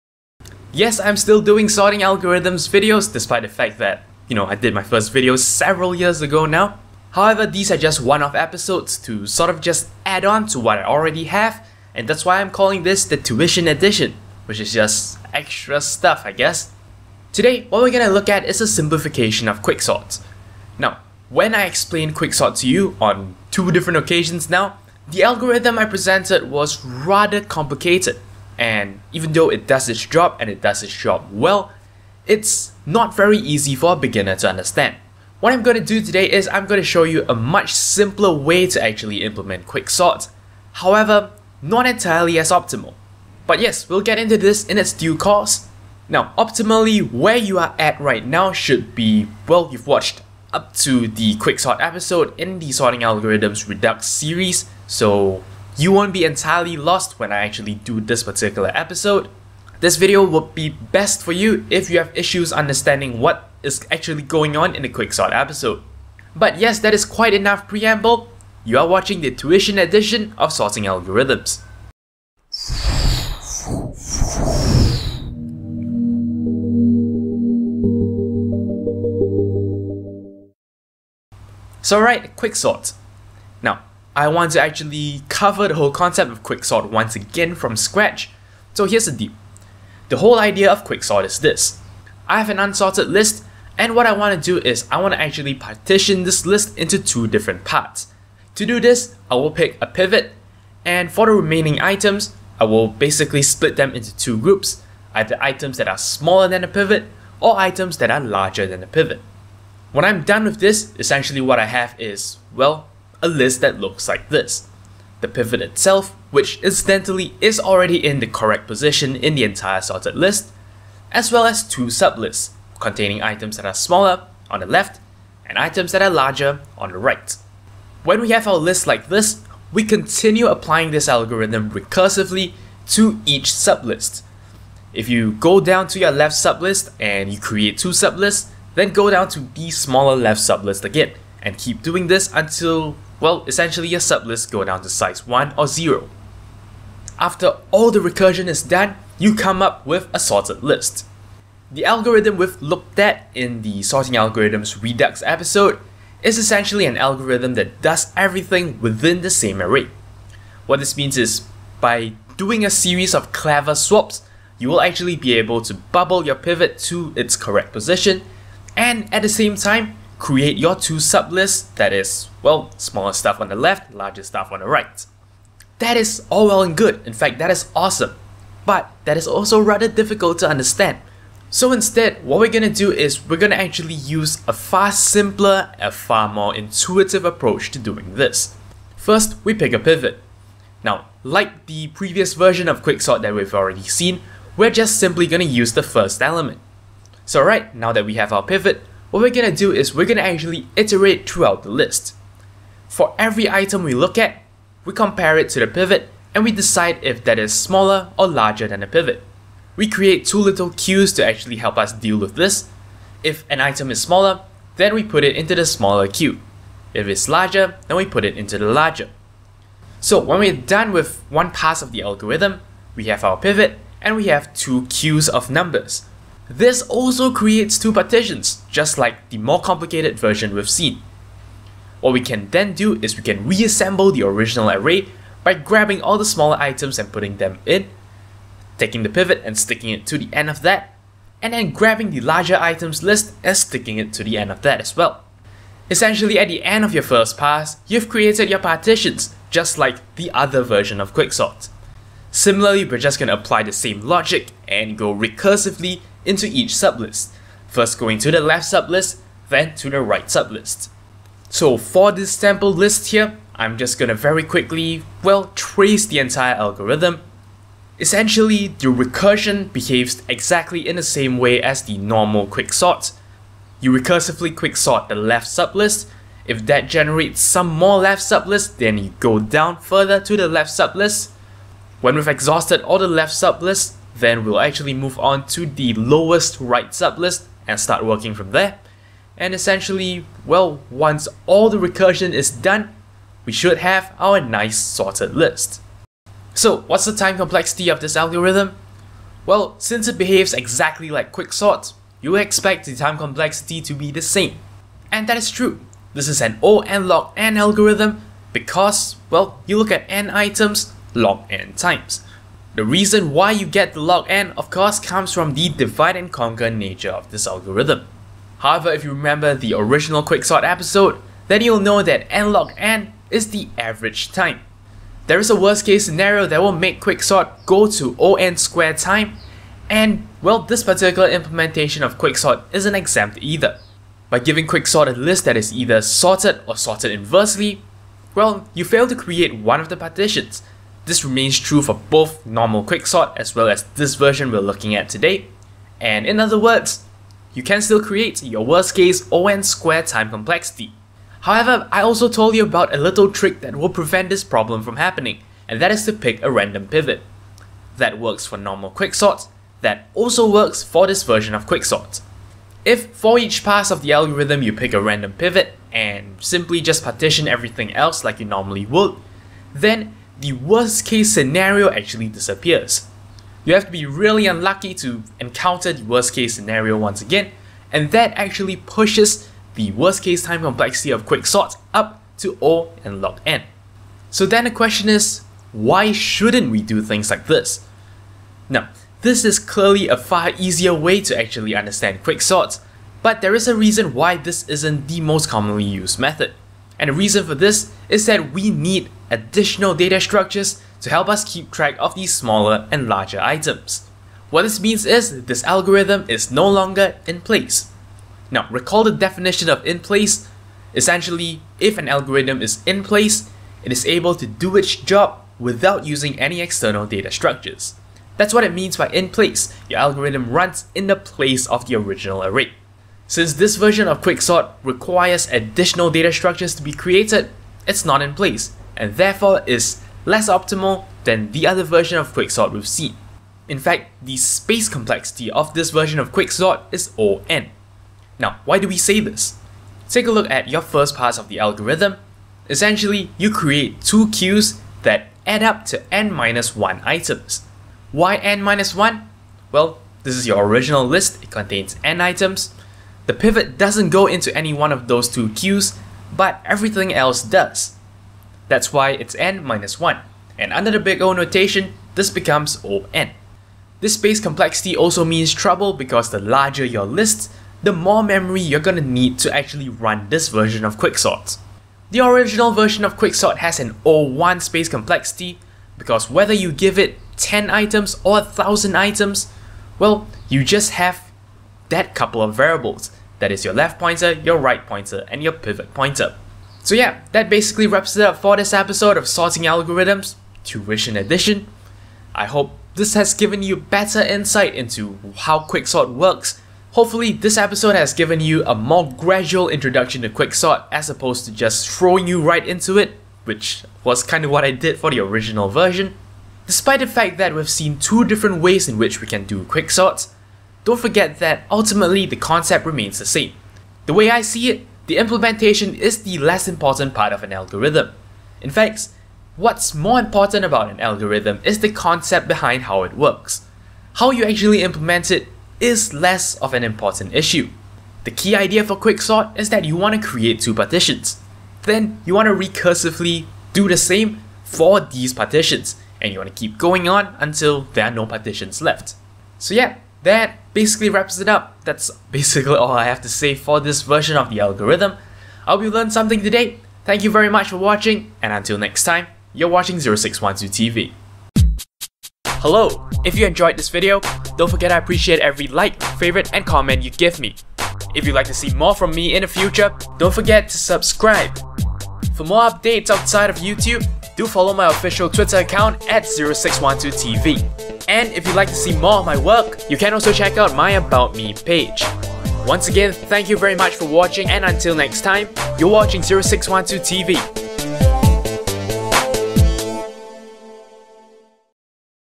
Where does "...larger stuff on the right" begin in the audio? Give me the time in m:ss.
2:53.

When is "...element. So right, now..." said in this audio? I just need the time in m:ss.
3:16.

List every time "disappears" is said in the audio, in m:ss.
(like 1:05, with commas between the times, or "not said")
6:12.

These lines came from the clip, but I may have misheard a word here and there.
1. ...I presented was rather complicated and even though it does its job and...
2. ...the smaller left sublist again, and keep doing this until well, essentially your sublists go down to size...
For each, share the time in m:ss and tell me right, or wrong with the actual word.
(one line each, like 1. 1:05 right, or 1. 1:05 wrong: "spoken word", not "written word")
1. 0:25 right
2. 2:19 right.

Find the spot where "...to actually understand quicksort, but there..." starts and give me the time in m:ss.
6:31.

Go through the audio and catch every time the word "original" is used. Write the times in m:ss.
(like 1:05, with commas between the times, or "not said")
3:54, 5:19, 7:01, 7:30, 7:52, 8:25.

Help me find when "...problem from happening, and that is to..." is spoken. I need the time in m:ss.
5:54.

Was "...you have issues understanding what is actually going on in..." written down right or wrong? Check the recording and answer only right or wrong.
right.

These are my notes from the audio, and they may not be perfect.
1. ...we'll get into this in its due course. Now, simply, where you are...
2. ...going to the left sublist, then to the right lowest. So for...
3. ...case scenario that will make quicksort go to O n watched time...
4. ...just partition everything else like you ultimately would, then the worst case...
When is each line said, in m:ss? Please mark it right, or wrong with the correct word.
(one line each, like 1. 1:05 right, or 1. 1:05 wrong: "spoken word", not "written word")
1. 0:43 wrong: "optimally", not "simply"
2. 4:17 wrong: "sublist", not "lowest"
3. 5:25 wrong: "squared", not "watched"
4. 6:06 wrong: "normally", not "ultimately".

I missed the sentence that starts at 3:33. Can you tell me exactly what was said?
If an item is smaller, then we put it into the smaller queue.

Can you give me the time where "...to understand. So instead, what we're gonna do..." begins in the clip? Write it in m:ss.
3:00.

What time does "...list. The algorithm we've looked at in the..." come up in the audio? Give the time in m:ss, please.
2:30.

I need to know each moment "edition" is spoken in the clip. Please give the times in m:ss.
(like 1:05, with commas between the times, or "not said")
0:13, 1:09, 8:11.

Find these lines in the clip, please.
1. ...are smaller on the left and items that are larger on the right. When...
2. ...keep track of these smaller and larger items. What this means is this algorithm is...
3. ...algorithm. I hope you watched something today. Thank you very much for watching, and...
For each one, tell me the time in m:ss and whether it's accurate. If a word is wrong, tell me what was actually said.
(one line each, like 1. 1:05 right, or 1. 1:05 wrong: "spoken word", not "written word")
1. 2:03 right
2. 6:41 right
3. 9:04 wrong: "learned", not "watched".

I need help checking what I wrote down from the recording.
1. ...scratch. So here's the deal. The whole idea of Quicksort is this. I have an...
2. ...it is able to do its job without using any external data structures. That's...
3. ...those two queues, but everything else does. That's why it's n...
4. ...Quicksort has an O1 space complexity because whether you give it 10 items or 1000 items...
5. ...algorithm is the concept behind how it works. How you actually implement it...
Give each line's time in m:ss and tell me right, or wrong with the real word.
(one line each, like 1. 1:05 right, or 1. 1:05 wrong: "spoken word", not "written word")
1. 1:27 right
2. 6:53 right
3. 7:35 right
4. 7:53 right
5. 8:40 right.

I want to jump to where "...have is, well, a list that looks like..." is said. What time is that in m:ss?
1:51.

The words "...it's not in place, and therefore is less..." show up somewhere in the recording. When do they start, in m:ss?
7:07.